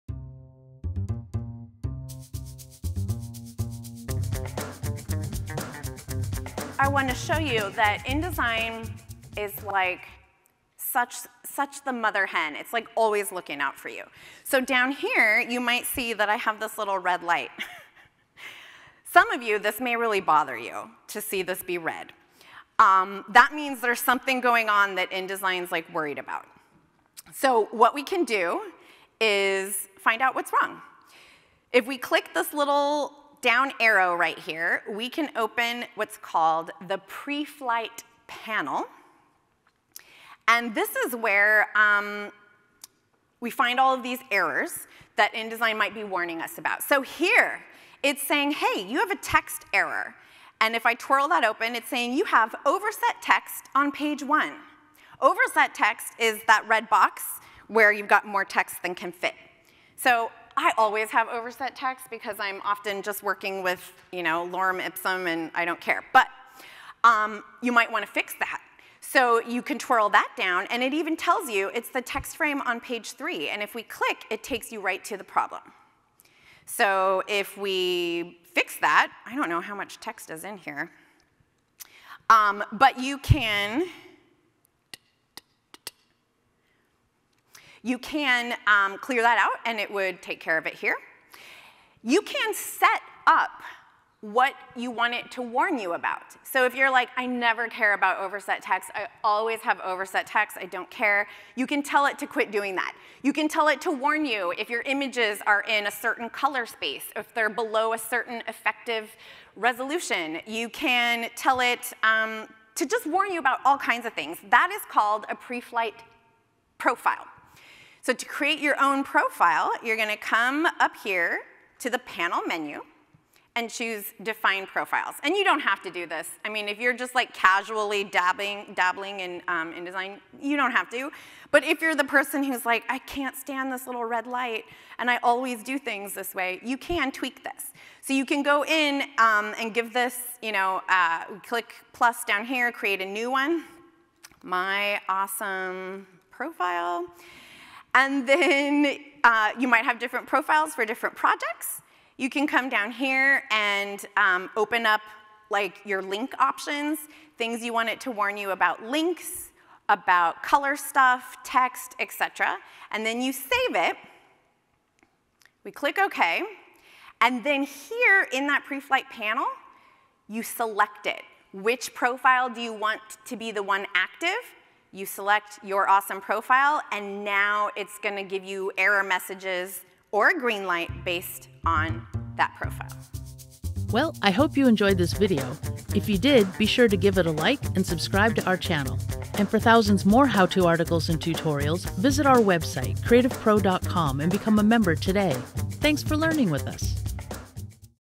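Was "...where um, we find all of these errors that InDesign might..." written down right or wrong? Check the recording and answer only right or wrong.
right.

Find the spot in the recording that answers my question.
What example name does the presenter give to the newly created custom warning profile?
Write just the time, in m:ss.
2:24.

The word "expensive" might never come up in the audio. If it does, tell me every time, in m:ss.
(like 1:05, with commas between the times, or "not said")
not said.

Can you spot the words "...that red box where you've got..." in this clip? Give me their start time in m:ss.
0:56.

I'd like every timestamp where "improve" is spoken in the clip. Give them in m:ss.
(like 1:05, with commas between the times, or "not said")
not said.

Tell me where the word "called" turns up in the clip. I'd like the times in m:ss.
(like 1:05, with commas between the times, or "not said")
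0:36, 1:54.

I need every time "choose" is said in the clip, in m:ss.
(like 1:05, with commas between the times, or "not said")
2:03.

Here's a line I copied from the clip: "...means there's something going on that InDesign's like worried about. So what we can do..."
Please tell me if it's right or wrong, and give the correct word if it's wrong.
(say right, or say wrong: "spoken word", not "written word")
right.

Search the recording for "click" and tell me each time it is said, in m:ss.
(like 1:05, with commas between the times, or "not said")
0:31, 1:13, 2:21, 2:45.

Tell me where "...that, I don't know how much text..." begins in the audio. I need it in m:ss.
1:18.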